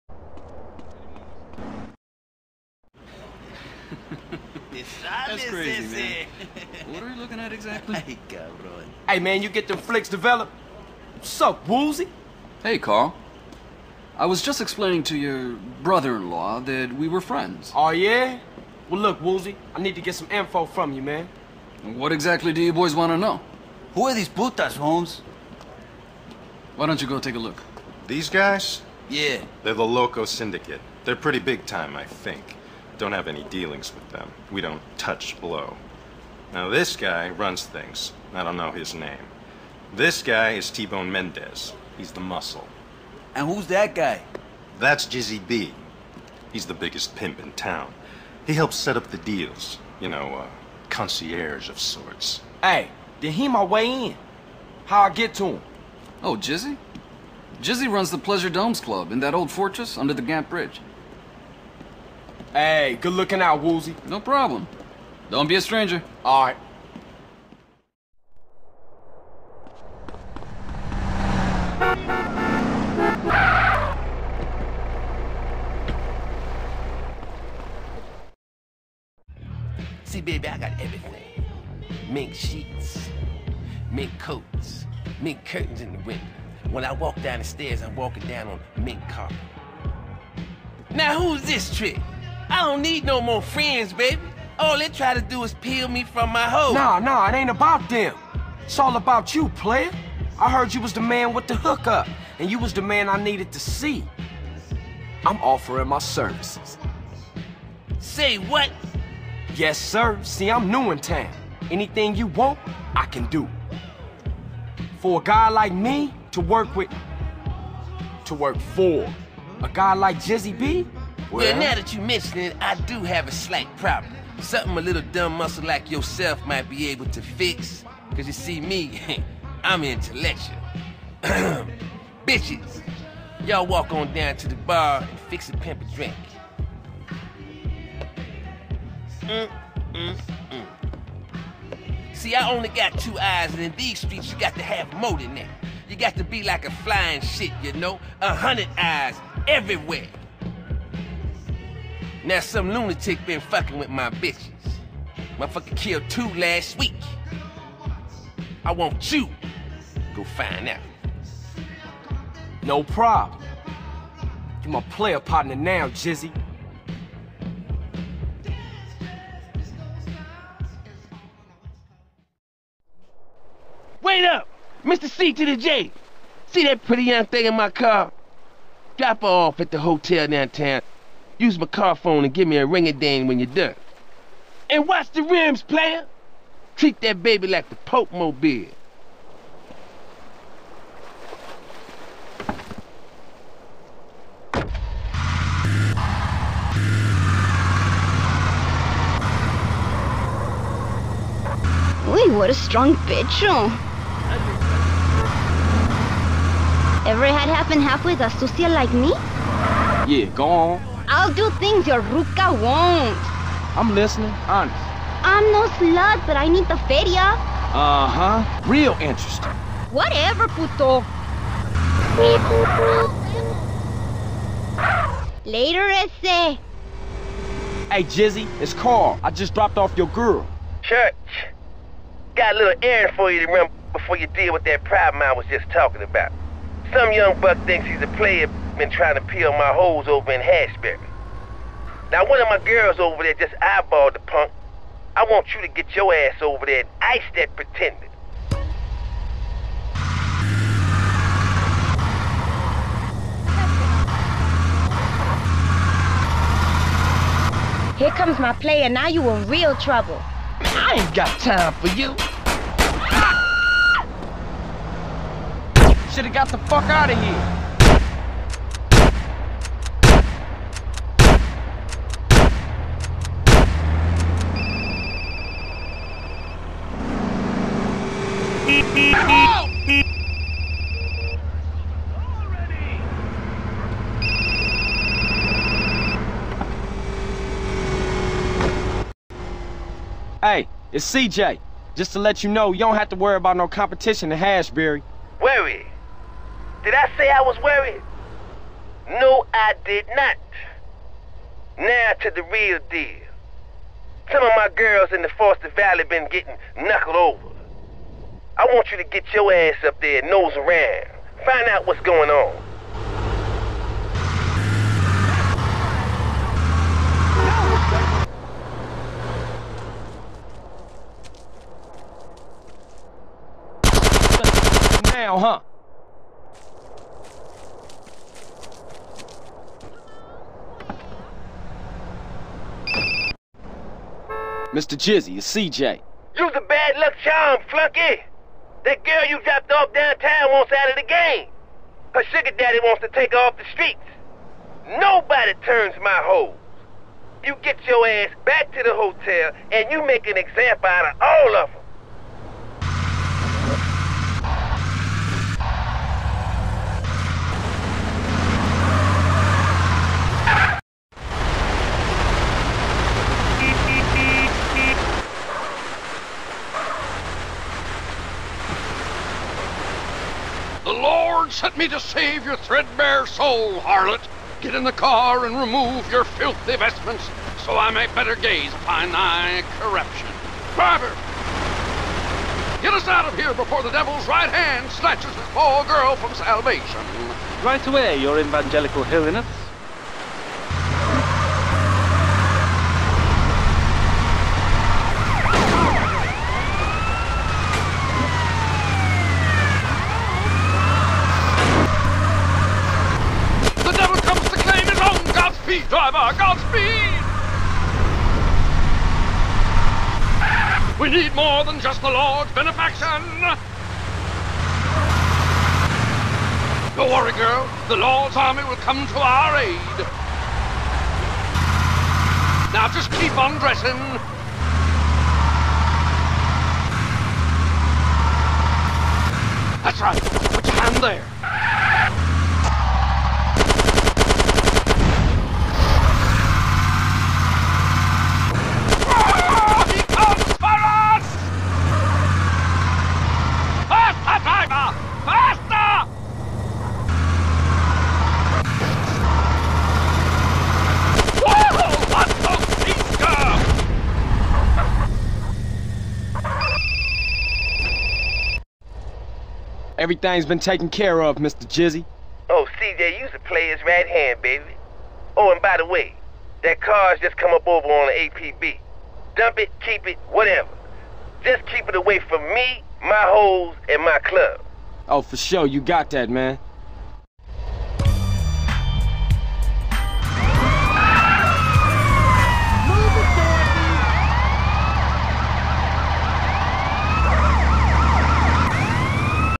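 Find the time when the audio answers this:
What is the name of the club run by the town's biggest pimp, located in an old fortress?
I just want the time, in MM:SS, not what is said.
00:58.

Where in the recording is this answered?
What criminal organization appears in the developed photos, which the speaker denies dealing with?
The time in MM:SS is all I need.
00:29.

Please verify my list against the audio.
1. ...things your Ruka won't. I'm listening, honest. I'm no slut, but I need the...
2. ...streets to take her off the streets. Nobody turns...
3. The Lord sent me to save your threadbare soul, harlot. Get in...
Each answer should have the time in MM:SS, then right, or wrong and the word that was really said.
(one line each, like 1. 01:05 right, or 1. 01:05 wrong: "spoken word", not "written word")
1. 03:31 right
2. 05:42 wrong: "wants", not "streets"
3. 06:10 right.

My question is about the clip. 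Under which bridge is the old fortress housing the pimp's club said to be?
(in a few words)
Gant Bridge.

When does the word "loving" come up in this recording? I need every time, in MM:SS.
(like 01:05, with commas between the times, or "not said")
not said.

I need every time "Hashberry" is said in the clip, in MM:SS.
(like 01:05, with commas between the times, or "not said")
04:00, 04:54.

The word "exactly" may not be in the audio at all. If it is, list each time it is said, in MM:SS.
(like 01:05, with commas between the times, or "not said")
00:07, 00:22.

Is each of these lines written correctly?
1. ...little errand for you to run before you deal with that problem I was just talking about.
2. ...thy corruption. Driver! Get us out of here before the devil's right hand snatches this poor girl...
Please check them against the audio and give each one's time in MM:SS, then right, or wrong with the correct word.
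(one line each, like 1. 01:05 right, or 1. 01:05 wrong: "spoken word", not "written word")
1. 03:52 right
2. 06:19 right.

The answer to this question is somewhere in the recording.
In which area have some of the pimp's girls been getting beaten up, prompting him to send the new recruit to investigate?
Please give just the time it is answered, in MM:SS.
05:05.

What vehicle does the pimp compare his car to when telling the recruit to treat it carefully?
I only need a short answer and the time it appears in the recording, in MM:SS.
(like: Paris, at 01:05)
Pope Mobile, at 03:07.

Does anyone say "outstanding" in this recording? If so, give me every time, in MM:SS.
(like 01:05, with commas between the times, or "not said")
not said.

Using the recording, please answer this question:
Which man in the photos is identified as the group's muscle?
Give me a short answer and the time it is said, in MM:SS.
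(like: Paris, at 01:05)
T-Bone Mendez, at 00:40.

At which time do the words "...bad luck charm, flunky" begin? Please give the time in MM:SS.
05:36.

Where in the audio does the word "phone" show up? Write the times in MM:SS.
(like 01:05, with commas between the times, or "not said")
03:01.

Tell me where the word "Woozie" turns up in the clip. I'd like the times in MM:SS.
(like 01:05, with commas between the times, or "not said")
00:11, 00:19, 01:03.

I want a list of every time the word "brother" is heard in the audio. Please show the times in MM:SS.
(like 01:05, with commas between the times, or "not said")
00:15.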